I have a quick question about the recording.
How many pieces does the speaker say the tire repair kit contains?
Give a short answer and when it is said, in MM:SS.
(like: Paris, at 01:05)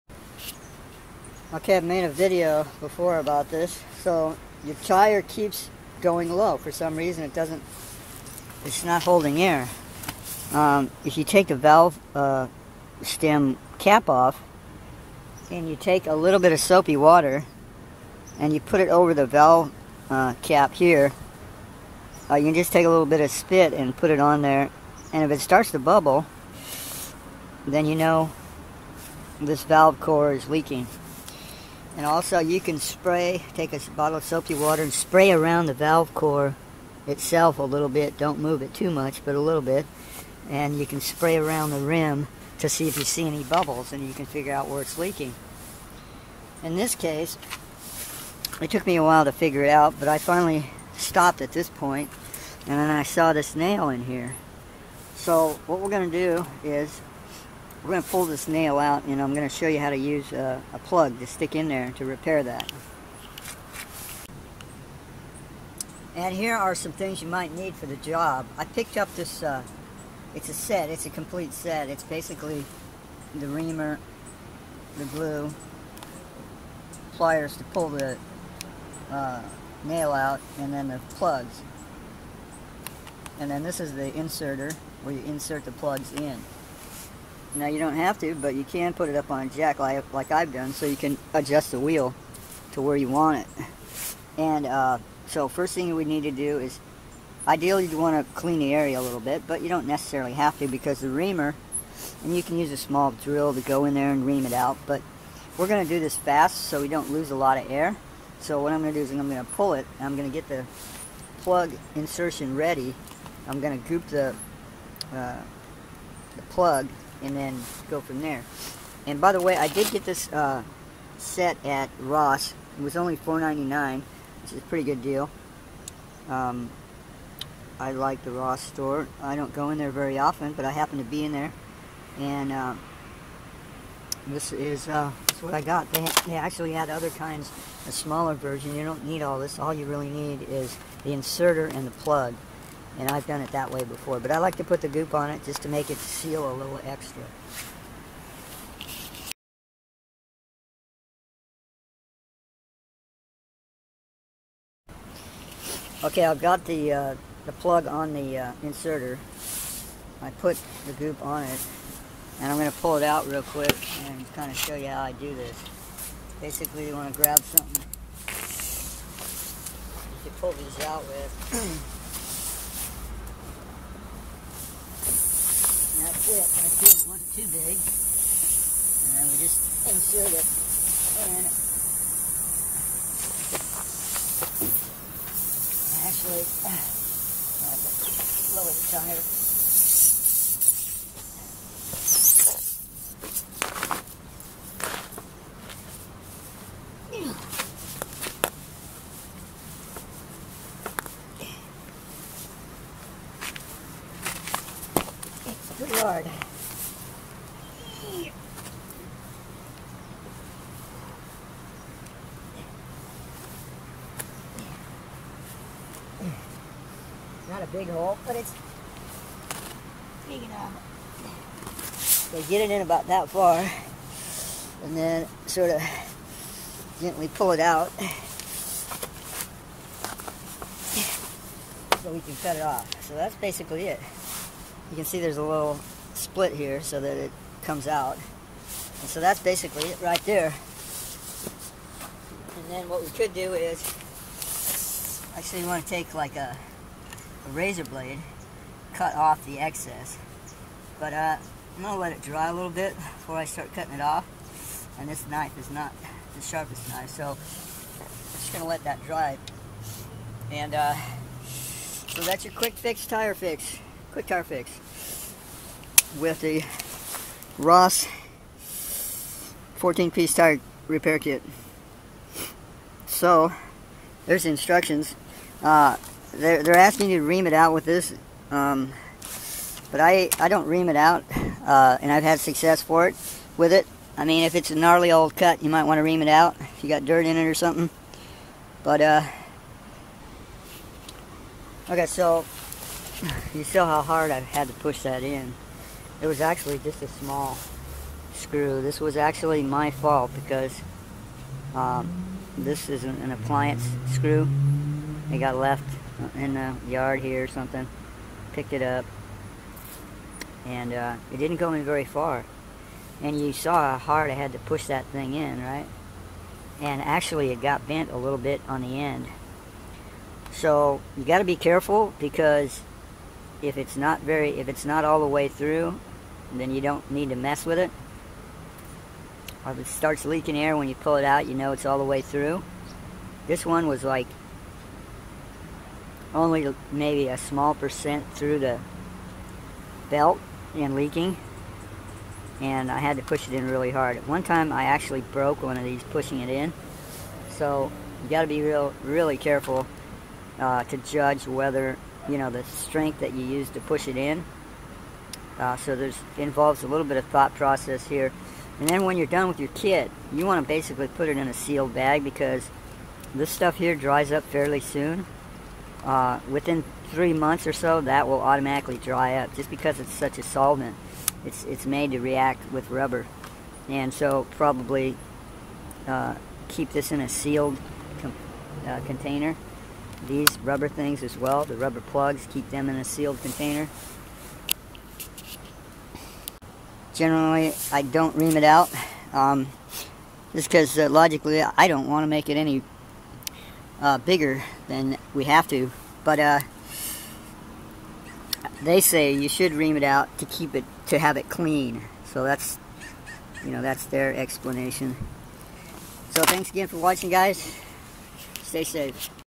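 14, at 04:29.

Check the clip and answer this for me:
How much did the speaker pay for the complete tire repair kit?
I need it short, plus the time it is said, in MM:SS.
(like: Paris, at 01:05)
$4.99, at 02:03.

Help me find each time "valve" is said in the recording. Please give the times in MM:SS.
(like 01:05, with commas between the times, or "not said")
00:11, 00:19, 00:29, 00:35.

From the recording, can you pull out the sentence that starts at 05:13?
And you saw how hard I had to push that thing in, right?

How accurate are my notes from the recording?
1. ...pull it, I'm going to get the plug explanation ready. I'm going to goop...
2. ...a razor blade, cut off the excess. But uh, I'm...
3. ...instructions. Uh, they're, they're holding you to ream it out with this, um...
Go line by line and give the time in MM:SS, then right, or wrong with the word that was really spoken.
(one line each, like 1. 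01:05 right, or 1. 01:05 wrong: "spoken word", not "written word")
1. 01:49 wrong: "insertion", not "explanation"
2. 04:07 right
3. 04:34 wrong: "asking", not "holding".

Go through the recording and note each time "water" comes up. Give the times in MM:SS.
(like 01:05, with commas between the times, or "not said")
00:16, 00:34.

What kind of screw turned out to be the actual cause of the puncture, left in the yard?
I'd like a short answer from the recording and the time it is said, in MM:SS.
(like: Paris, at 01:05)
appliance screw, at 05:03.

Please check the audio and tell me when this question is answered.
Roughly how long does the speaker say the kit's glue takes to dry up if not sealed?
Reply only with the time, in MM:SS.
06:07.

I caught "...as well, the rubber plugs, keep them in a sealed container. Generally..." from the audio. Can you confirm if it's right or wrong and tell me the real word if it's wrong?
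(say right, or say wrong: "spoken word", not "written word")
right.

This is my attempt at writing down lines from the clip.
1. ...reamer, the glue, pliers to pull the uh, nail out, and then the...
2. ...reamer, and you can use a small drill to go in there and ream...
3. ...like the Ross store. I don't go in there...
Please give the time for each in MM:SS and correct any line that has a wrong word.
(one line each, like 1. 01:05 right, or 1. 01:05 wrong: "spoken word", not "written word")
1. 01:13 right
2. 01:41 right
3. 02:07 right.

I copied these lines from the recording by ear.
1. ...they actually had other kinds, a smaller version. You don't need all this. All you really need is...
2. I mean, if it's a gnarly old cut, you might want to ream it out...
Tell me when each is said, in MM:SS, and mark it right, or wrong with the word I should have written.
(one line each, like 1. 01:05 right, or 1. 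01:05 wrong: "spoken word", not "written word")
1. 02:16 right
2. 04:44 right.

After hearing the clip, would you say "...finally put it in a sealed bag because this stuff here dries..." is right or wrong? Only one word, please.
wrong.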